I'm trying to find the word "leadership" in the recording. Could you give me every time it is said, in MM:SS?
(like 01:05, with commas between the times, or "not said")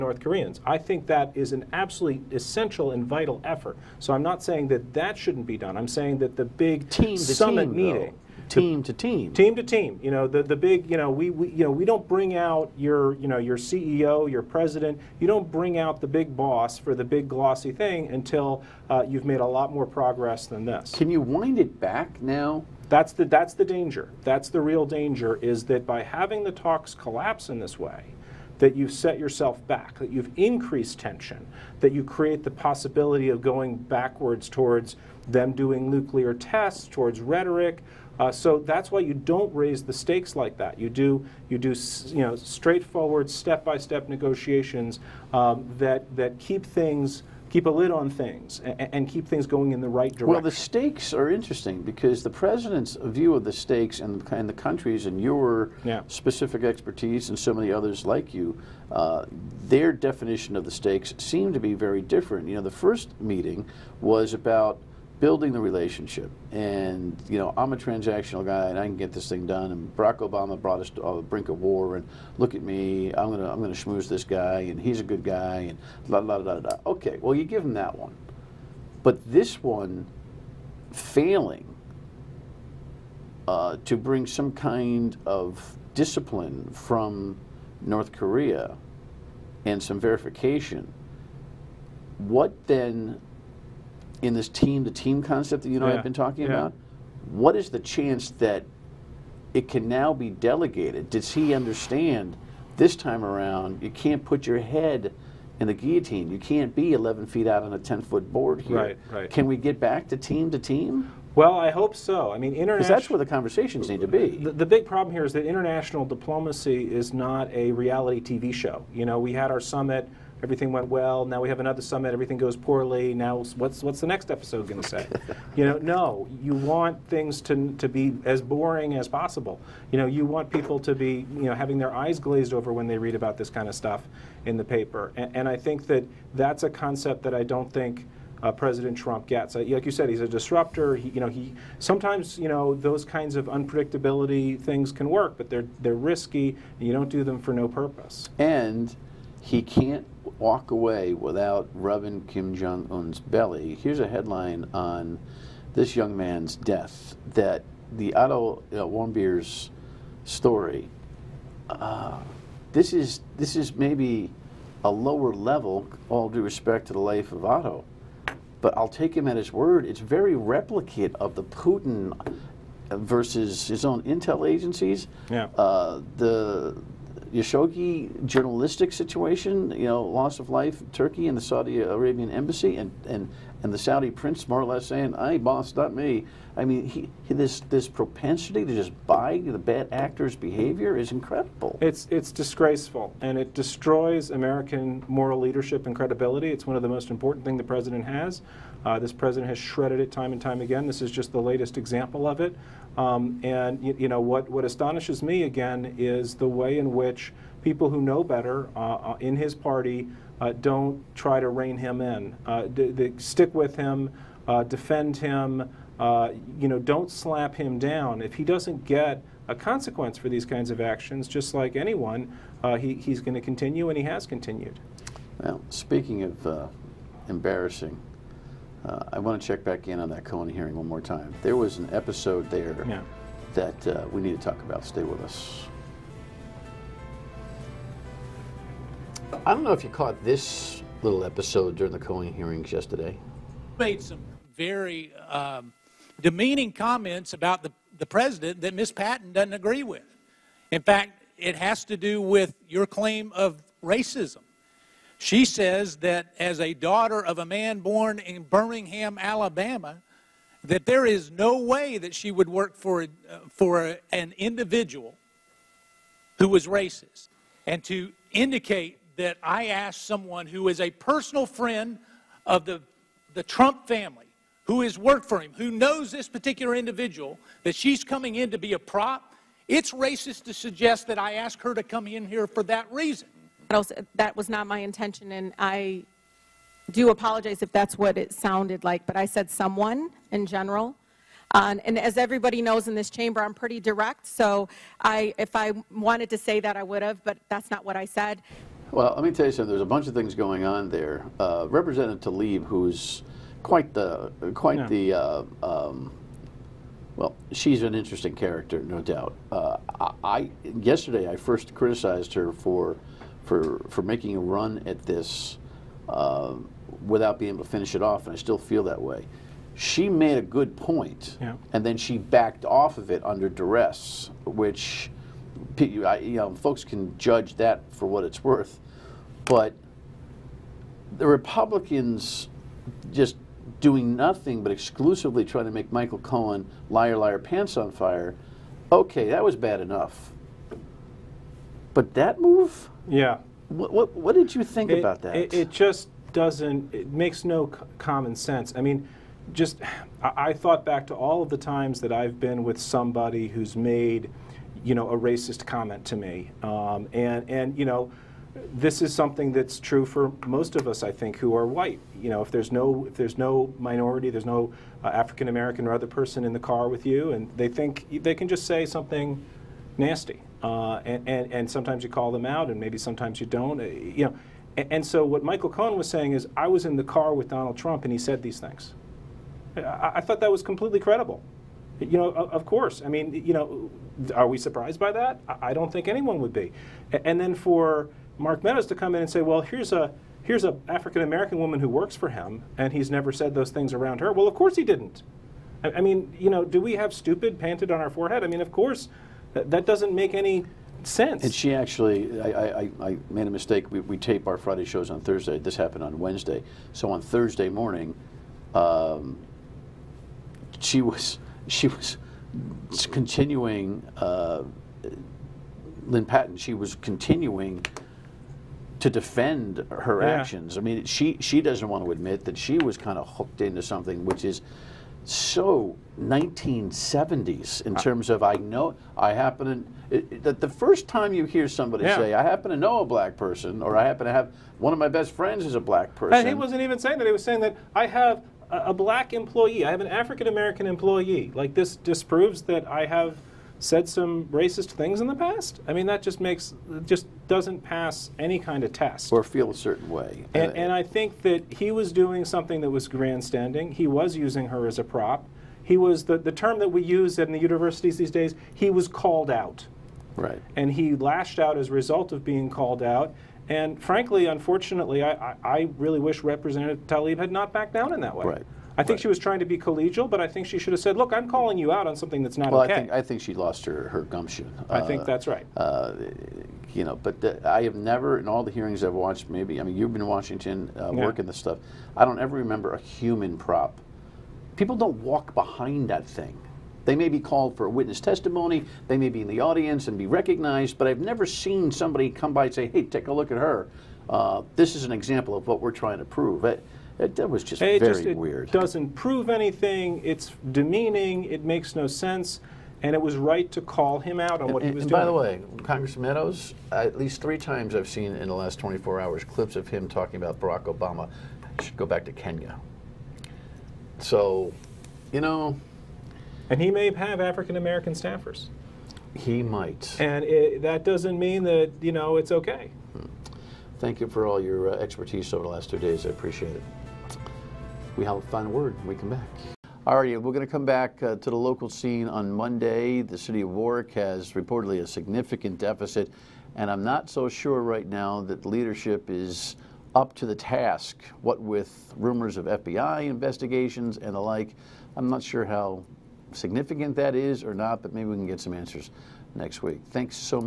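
03:15, 08:58.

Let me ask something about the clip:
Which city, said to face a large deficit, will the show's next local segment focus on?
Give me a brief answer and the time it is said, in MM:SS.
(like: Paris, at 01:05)
Warwick, at 08:53.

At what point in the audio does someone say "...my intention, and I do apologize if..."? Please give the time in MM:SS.
04:44.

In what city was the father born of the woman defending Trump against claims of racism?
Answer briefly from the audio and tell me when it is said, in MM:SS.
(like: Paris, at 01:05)
Birmingham, Alabama, at 04:18.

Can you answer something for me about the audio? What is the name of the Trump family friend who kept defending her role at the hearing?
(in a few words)
Lynn Patton.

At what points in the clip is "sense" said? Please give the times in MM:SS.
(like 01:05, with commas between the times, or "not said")
05:48, 06:41, 08:22.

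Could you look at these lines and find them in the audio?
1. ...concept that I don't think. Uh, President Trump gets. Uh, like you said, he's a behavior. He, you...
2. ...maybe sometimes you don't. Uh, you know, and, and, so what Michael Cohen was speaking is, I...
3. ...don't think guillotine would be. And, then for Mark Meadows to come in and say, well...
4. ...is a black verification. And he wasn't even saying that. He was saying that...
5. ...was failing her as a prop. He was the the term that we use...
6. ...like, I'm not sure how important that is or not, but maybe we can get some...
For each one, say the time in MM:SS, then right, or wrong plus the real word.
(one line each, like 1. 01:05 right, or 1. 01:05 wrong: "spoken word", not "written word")
1. 02:16 wrong: "disruptor", not "behavior"
2. 06:12 wrong: "saying", not "speaking"
3. 06:25 wrong: "anyone", not "guillotine"
4. 07:15 wrong: "person", not "verification"
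5. 07:34 wrong: "using", not "failing"
6. 09:04 wrong: "significant", not "important".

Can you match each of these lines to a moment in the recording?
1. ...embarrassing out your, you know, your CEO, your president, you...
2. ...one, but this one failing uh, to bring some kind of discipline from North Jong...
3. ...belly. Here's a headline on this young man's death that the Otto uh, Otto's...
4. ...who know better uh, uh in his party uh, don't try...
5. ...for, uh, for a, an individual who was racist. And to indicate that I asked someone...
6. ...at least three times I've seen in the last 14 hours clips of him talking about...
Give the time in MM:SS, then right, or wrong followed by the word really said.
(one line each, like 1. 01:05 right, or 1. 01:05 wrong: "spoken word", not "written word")
1. 00:12 wrong: "bring", not "embarrassing"
2. 01:17 wrong: "Korea", not "Jong"
3. 02:33 wrong: "Warmbier", not "Otto"
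4. 03:27 right
5. 04:22 right
6. 08:26 wrong: "24", not "14".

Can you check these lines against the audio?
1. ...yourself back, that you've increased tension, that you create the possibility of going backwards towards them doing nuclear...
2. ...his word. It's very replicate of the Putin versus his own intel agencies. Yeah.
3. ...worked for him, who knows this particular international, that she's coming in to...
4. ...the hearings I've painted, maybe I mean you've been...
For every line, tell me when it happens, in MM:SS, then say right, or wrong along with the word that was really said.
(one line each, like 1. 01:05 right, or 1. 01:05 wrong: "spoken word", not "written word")
1. 00:29 right
2. 02:49 right
3. 04:34 wrong: "individual", not "international"
4. 07:58 wrong: "watched", not "painted".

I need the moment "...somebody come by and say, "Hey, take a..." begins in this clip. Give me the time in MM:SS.
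08:11.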